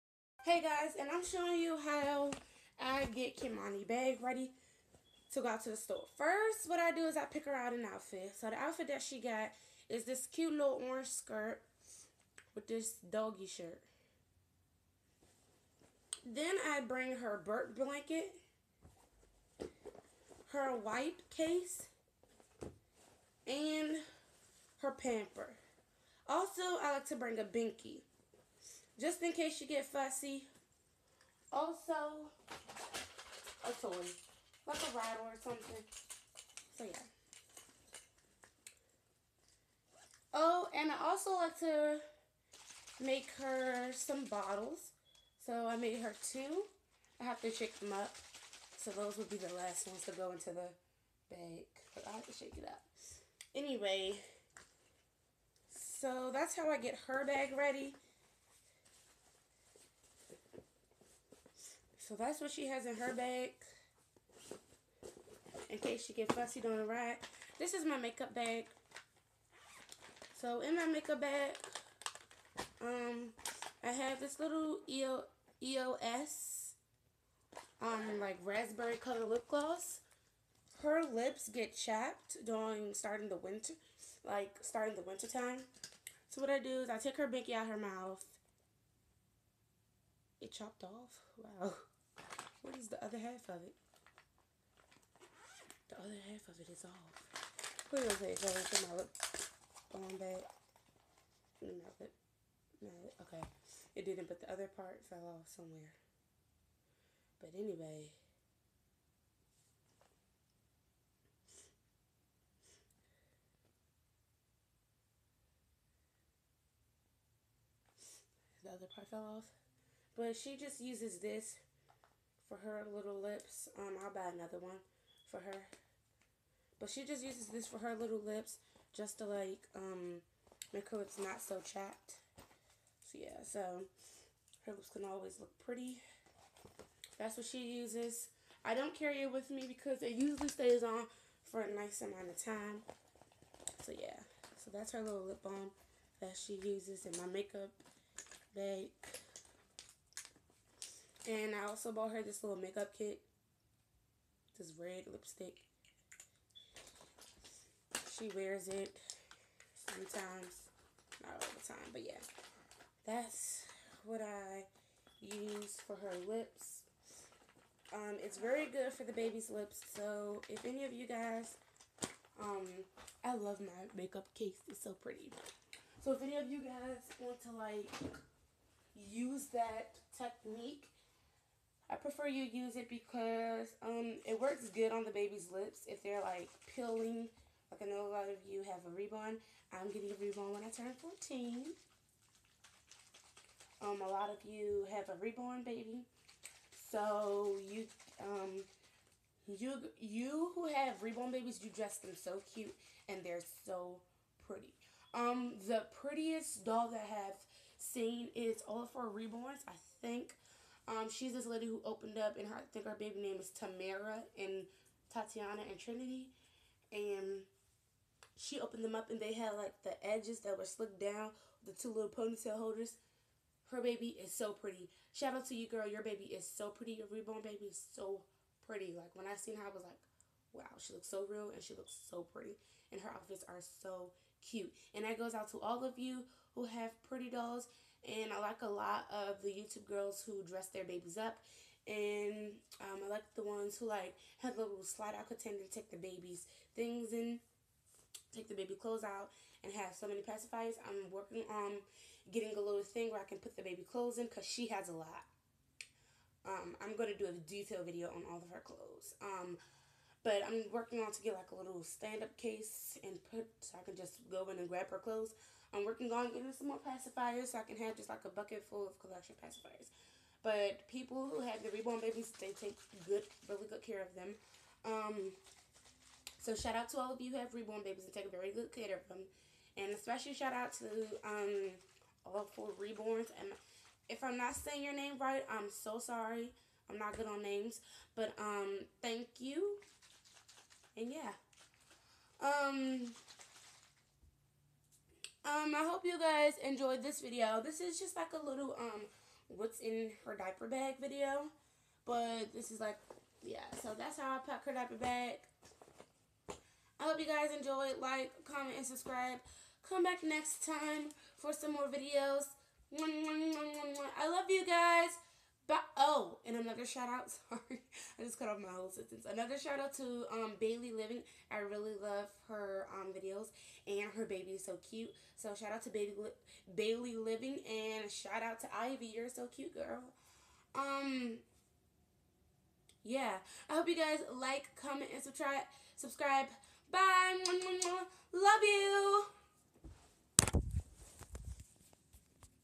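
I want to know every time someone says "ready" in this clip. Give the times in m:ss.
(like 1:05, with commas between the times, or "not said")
0:04, 0:57.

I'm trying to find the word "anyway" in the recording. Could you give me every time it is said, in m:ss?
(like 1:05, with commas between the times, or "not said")
0:53, 1:47.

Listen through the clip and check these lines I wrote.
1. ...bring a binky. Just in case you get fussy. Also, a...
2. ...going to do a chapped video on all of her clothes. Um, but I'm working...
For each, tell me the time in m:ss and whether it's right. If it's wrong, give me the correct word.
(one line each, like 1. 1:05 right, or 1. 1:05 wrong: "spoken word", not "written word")
1. 0:27 right
2. 4:16 wrong: "detailed", not "chapped".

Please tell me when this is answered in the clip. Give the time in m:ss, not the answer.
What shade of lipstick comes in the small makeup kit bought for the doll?
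2:34.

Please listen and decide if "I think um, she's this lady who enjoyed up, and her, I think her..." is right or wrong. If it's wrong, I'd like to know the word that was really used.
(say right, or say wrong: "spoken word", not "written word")
wrong: "opened", not "enjoyed".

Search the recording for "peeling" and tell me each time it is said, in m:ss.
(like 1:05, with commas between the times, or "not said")
3:06.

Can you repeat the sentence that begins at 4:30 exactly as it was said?
But people who have the reborn babies, they take good, really good care of them.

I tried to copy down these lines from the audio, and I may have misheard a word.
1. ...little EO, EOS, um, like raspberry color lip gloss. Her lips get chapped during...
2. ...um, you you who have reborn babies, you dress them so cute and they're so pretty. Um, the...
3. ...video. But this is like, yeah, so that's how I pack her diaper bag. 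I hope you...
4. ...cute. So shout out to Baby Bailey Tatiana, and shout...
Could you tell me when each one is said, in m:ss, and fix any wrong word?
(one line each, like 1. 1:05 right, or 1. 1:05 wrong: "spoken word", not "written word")
1. 1:14 right
2. 3:18 right
3. 5:00 right
4. 5:24 wrong: "Living", not "Tatiana".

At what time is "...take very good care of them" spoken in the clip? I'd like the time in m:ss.
4:38.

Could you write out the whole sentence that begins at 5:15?
But oh, and another shout out.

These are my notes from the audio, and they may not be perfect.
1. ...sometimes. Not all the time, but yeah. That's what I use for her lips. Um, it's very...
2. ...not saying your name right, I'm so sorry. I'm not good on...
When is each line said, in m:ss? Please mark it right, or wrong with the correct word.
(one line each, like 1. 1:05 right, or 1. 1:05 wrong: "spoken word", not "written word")
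1. 2:39 right
2. 4:44 right.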